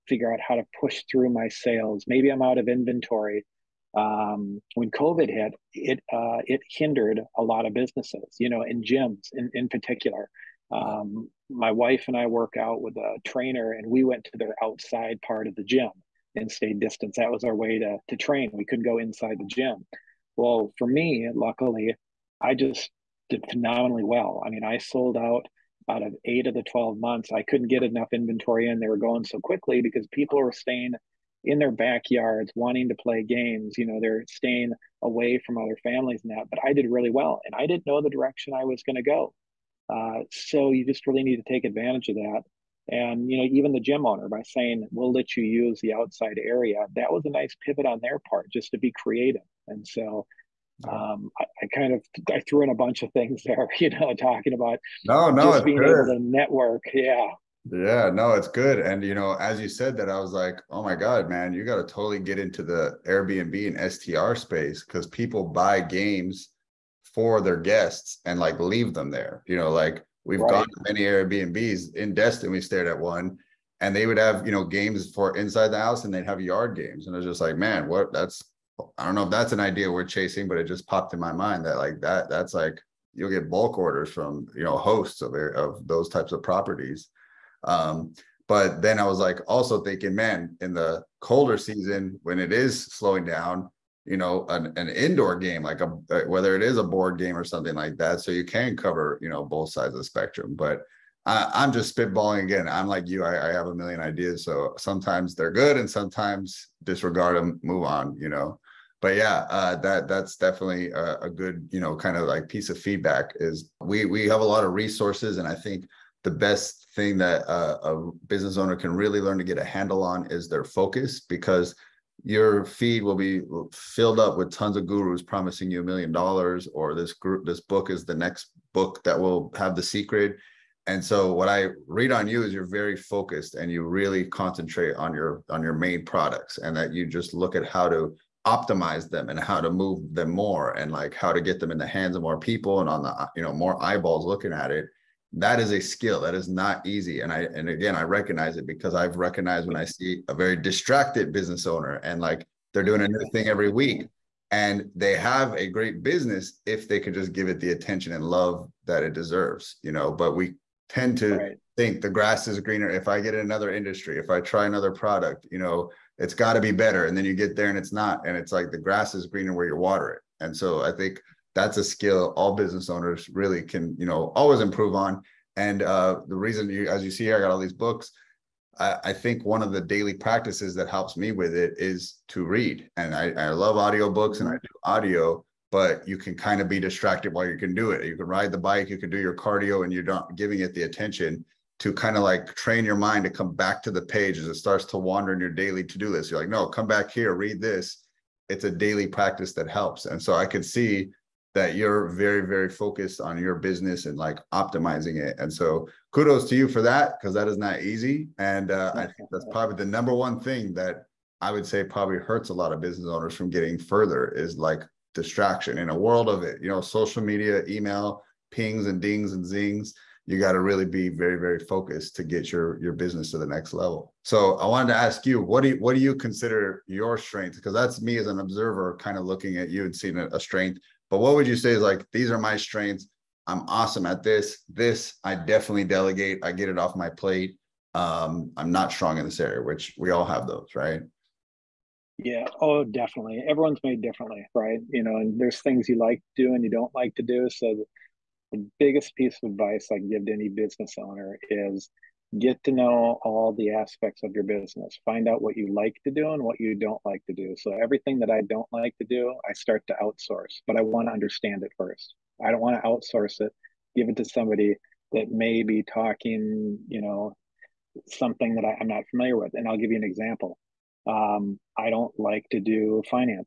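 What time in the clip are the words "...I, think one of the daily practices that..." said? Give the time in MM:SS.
02:59.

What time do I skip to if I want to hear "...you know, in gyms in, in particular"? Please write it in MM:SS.
00:08.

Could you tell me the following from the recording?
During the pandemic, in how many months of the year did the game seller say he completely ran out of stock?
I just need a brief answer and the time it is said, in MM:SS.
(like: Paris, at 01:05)
8, at 00:26.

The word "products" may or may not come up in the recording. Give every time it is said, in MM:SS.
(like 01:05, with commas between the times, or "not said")
02:16, 02:44.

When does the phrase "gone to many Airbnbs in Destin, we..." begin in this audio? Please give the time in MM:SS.
01:10.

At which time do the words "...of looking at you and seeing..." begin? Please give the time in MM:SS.
03:49.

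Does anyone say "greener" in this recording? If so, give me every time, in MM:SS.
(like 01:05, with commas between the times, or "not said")
02:42, 02:49.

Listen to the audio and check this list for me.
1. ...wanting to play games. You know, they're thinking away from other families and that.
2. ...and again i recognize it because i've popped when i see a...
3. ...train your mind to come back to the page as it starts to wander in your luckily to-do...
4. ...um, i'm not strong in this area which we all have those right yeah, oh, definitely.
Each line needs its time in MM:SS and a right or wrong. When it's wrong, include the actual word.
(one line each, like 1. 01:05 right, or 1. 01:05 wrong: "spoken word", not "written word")
1. 00:32 wrong: "staying", not "thinking"
2. 02:27 wrong: "recognized", not "popped"
3. 03:12 wrong: "daily", not "luckily"
4. 03:57 right.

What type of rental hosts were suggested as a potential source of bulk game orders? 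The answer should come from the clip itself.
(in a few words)
Airbnb and STR.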